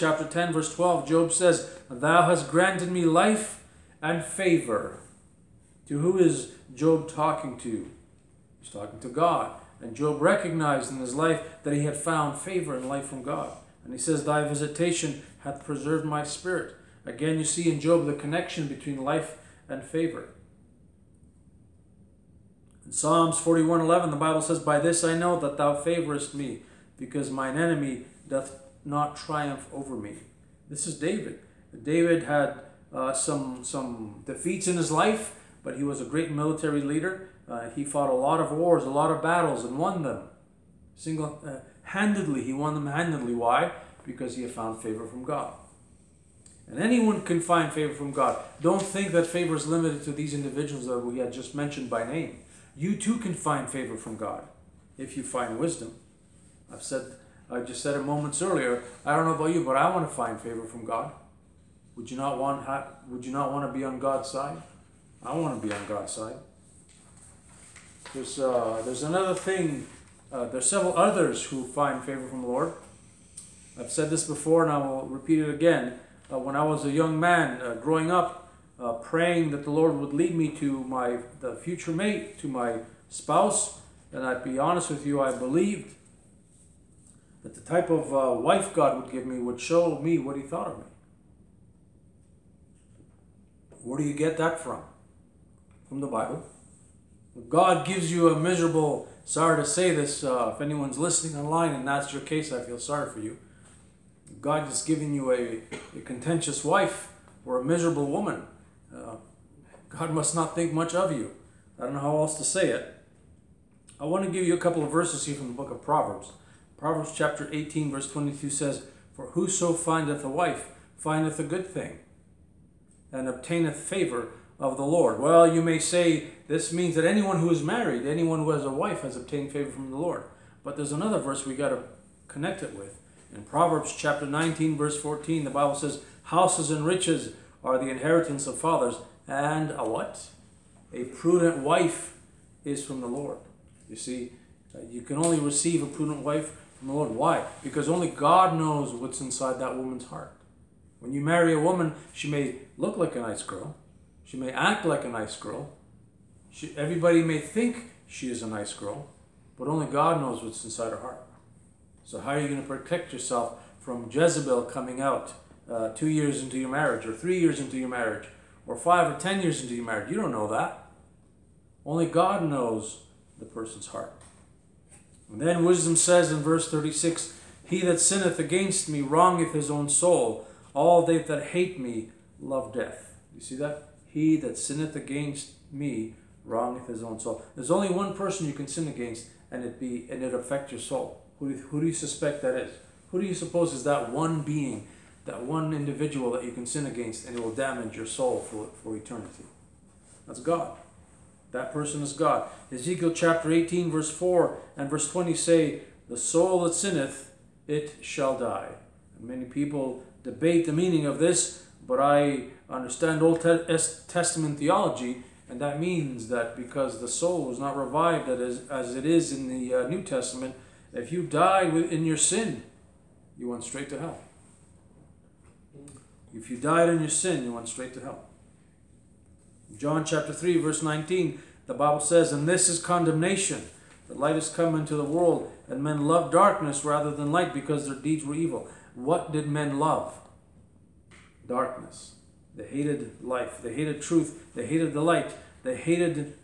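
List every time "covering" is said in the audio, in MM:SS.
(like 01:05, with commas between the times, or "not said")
not said.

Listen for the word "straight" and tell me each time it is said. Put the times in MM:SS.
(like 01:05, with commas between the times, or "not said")
03:43, 03:47.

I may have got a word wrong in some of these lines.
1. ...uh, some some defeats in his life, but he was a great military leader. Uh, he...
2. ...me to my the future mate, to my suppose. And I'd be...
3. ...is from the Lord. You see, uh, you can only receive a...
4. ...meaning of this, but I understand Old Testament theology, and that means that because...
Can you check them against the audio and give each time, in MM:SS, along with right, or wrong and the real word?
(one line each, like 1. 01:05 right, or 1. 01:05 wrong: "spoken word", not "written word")
1. 00:32 right
2. 01:20 wrong: "spouse", not "suppose"
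3. 02:22 right
4. 03:30 right.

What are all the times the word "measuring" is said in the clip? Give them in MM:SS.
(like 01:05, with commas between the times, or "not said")
not said.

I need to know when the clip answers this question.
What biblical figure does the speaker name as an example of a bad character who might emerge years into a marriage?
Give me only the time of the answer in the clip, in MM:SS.
02:44.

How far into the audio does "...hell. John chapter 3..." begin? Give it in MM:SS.
03:48.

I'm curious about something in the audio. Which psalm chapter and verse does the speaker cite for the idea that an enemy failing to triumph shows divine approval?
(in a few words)
Psalms 41:11.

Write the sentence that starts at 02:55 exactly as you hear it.
And then wisdom says in verse 36 He that sinneth against me wrongeth his own soul.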